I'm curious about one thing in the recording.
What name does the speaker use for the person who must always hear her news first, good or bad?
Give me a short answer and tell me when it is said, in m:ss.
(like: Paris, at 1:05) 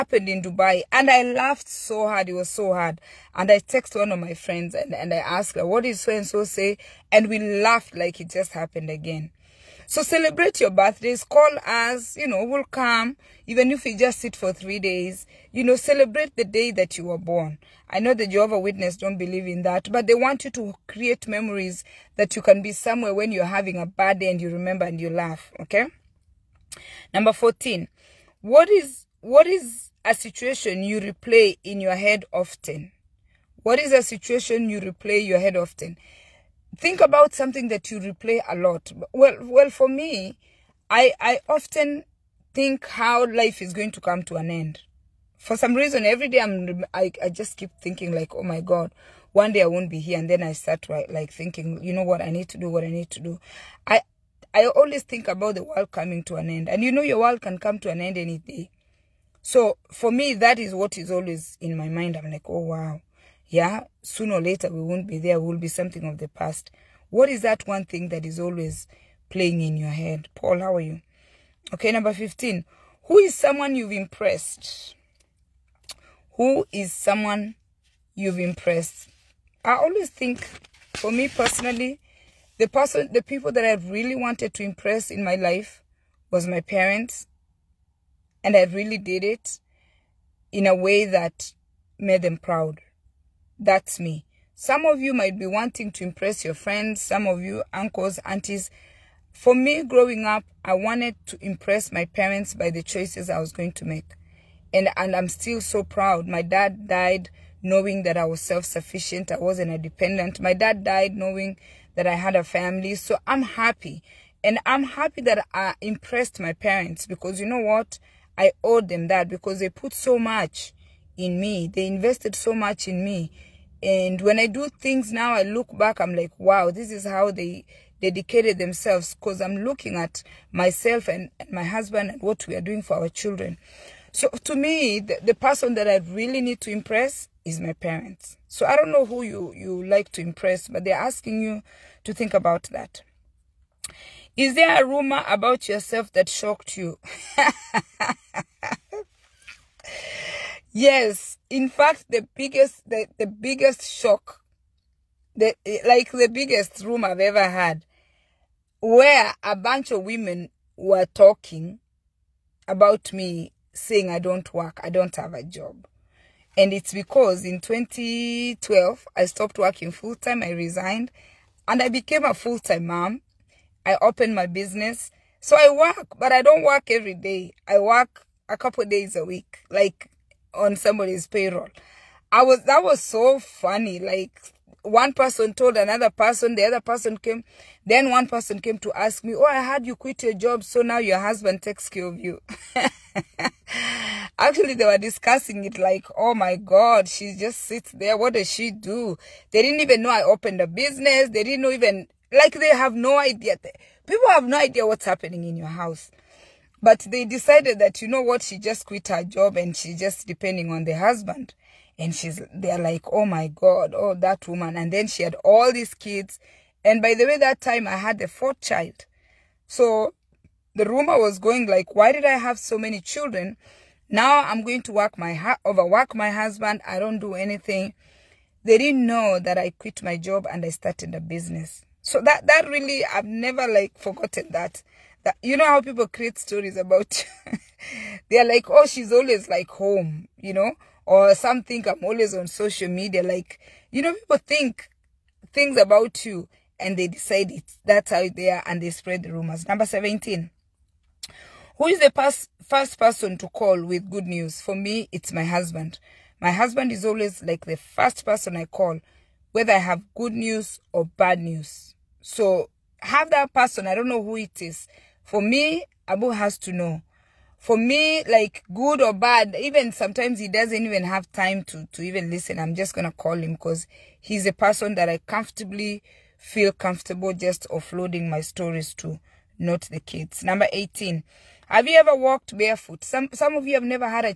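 Abu, at 4:26.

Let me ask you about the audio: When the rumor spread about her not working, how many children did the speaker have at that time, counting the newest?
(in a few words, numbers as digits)
4.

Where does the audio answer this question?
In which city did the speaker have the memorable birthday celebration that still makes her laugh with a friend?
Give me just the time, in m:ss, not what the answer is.
0:00.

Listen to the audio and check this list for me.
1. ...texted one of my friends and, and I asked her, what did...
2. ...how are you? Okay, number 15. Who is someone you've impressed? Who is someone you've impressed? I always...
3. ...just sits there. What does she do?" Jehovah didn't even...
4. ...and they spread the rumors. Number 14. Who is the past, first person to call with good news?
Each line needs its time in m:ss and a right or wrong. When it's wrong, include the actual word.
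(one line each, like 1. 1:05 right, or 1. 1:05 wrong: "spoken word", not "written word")
1. 0:03 right
2. 1:10 right
3. 3:17 wrong: "They", not "Jehovah"
4. 4:08 wrong: "17", not "14".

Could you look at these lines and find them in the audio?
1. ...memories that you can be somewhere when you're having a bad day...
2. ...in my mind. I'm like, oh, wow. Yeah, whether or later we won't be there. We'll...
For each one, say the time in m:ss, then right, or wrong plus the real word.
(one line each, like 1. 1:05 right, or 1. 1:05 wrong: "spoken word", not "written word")
1. 0:21 right
2. 1:01 wrong: "sooner", not "whether".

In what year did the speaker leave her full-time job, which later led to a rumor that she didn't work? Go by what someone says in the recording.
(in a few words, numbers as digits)
2012.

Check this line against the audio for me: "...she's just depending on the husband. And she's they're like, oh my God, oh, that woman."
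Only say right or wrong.
right.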